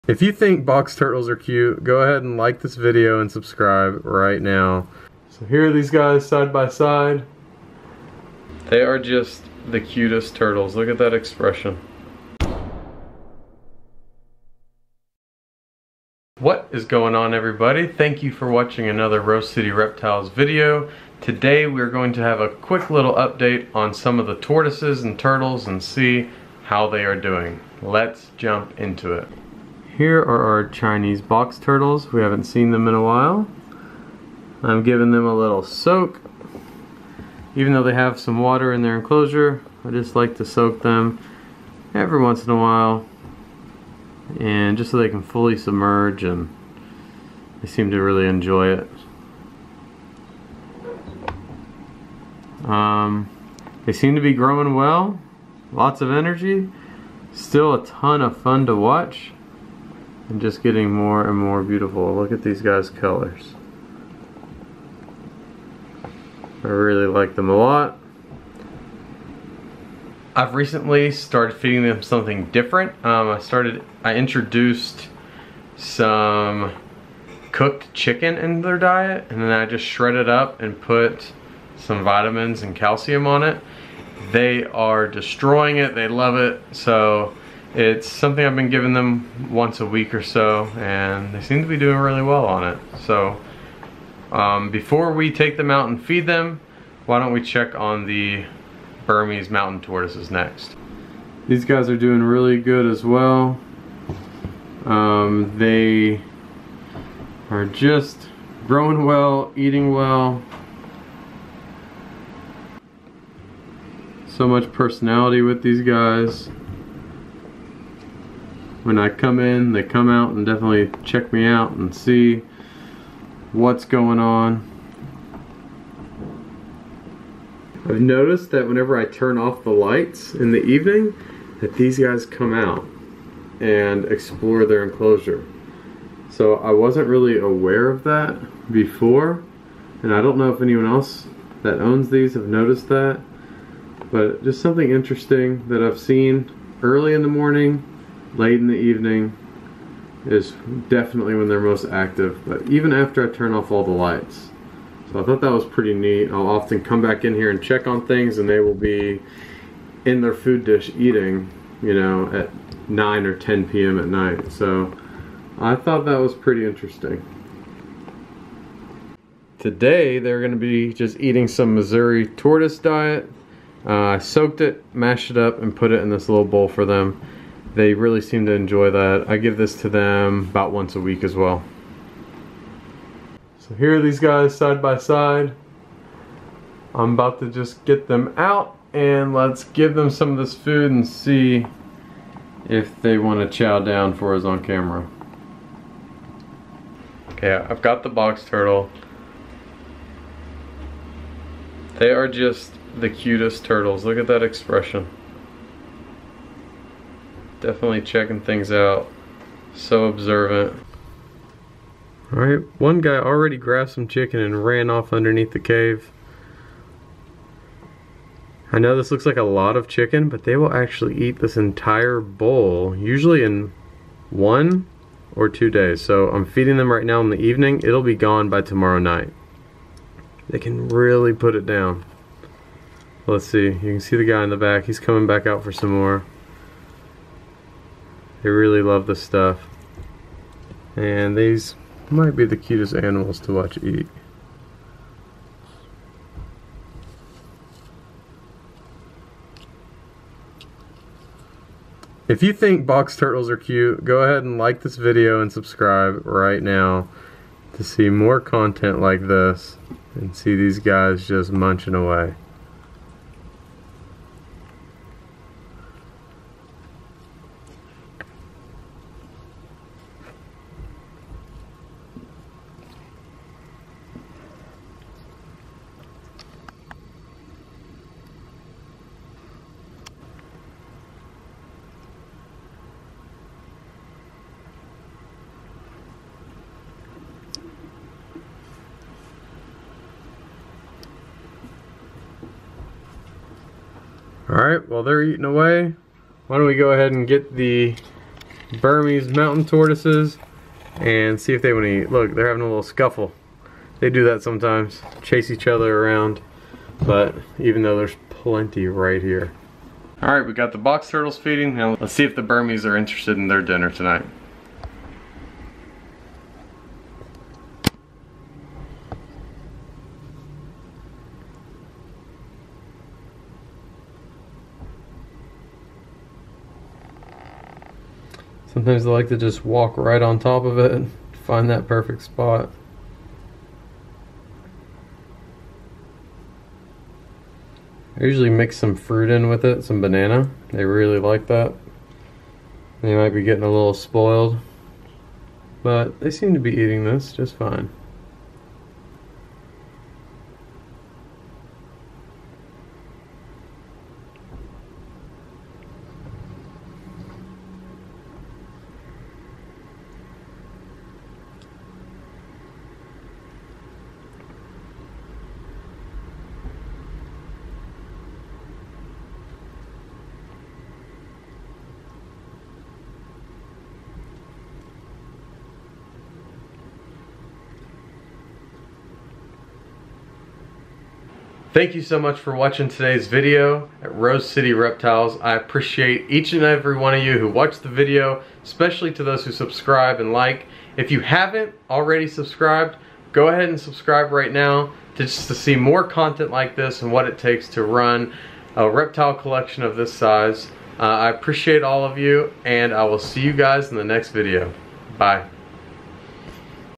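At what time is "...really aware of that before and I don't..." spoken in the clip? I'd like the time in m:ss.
2:17.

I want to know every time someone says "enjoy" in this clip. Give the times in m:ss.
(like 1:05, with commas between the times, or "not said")
0:48, 2:58.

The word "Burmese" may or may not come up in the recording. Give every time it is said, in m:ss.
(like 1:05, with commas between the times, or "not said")
1:39, 4:58, 5:12.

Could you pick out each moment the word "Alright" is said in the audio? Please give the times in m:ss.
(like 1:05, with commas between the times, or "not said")
3:32, 4:54, 5:10.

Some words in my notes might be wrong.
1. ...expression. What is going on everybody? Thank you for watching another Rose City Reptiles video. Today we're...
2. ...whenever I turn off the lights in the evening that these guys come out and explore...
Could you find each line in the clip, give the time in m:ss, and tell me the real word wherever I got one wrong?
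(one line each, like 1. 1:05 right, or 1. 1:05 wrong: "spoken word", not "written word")
1. 0:11 right
2. 2:08 right.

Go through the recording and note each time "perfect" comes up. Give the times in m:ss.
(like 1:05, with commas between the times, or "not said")
5:31.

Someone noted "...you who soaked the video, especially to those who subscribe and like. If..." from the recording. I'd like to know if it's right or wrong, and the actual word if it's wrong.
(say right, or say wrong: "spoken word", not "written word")
wrong: "watched", not "soaked".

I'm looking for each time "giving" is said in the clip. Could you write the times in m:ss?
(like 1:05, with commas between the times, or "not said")
0:34, 1:28.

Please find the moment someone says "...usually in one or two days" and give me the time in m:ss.
3:42.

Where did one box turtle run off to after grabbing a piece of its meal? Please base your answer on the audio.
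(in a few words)
Underneath the cave.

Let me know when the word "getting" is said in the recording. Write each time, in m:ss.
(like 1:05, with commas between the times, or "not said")
1:00, 5:43.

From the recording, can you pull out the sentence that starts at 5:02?
Look, they're having a little scuffle.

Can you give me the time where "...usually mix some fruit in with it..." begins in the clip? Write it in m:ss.
5:38.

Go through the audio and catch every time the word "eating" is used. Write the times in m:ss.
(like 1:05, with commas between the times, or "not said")
1:49, 2:40, 2:51, 4:55, 5:46.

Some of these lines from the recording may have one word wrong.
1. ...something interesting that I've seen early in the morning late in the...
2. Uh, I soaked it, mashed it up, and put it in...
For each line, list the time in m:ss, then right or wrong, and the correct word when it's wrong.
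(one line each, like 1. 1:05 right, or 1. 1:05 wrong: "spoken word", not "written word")
1. 2:24 right
2. 2:53 right.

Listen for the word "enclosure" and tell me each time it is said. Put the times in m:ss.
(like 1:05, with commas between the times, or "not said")
0:38, 2:14.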